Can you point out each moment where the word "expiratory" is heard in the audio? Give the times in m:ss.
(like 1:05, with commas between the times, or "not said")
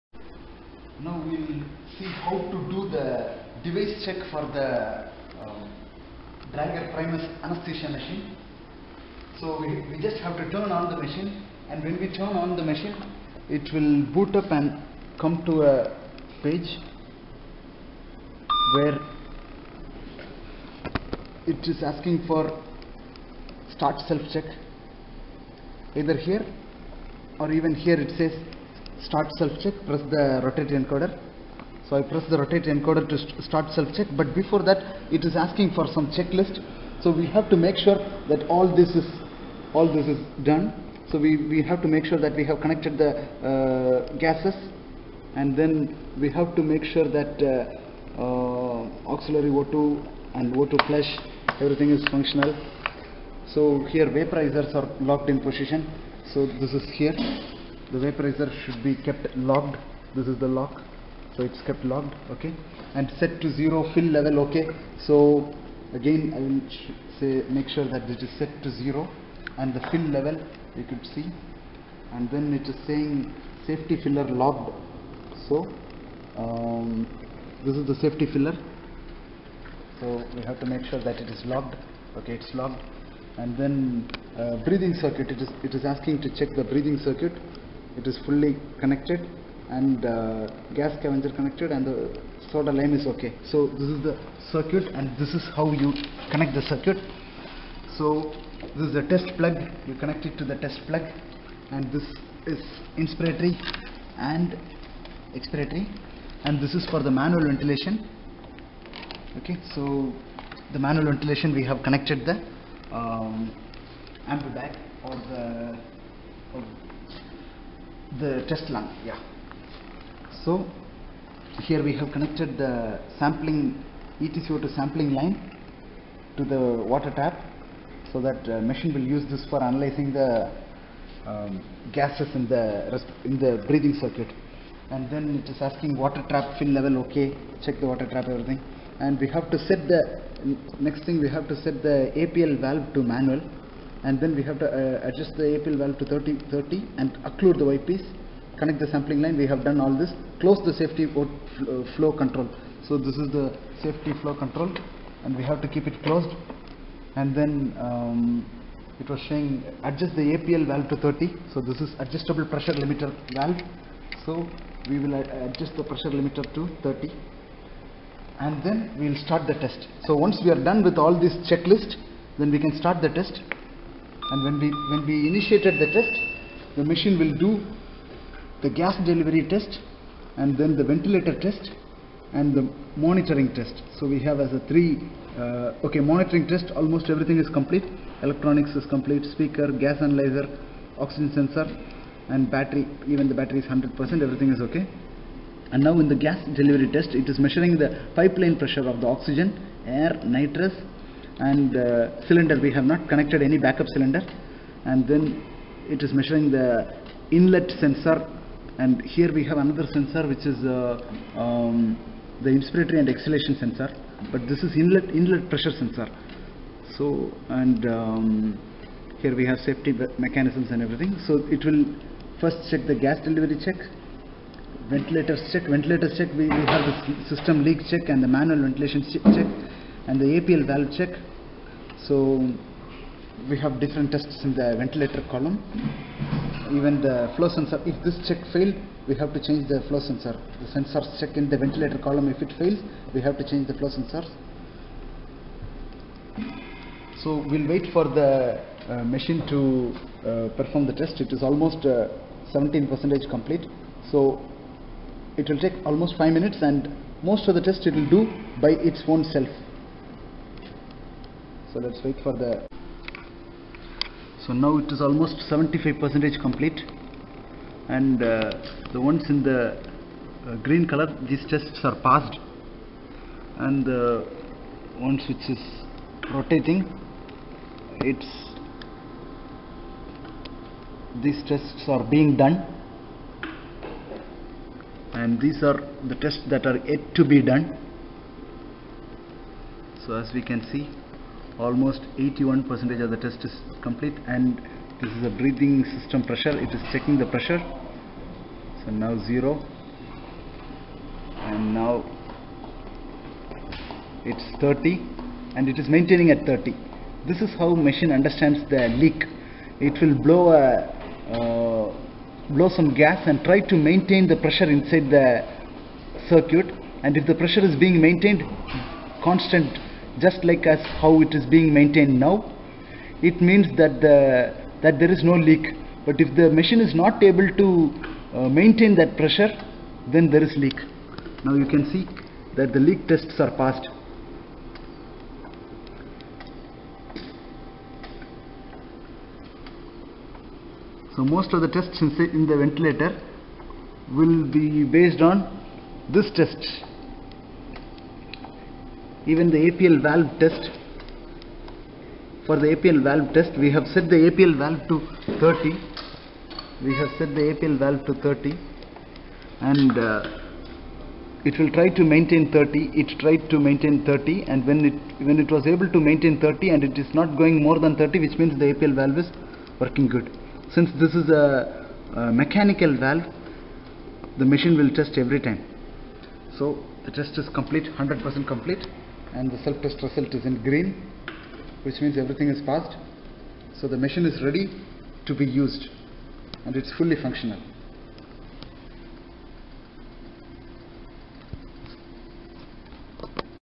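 1:45.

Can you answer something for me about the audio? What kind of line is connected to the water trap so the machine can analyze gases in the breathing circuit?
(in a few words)
ETCO2 sampling line.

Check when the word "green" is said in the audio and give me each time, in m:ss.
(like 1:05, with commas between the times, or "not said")
4:30, 6:20.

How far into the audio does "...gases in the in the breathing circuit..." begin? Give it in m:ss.
2:11.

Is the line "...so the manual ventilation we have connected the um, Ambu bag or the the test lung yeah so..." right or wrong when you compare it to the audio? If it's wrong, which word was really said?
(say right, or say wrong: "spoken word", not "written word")
right.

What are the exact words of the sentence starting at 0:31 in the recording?
So I press the rotate encoder to st start self-check, but before that it is asking for some checklist.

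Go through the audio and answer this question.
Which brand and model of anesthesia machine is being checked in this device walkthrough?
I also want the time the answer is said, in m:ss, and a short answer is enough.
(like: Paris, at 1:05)
Drager Primus, at 0:06.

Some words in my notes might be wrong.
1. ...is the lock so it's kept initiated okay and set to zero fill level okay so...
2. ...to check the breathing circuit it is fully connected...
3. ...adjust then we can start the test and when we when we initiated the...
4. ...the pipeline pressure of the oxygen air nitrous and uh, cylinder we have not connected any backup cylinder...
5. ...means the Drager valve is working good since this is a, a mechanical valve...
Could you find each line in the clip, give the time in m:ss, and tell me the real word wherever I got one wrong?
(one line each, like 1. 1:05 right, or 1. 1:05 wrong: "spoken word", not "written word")
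1. 1:00 wrong: "locked", not "initiated"
2. 1:26 right
3. 2:51 wrong: "checklist", not "adjust"
4. 3:17 right
5. 6:08 wrong: "APL", not "Drager".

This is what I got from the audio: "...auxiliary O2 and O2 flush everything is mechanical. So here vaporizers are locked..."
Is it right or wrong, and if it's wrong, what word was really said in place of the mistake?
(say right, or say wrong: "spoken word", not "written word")
wrong: "functional", not "mechanical".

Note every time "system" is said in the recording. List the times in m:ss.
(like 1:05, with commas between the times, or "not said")
3:47, 4:55.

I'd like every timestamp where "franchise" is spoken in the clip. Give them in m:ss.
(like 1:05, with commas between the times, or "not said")
not said.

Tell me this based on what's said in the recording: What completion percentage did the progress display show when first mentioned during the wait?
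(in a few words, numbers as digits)
17%.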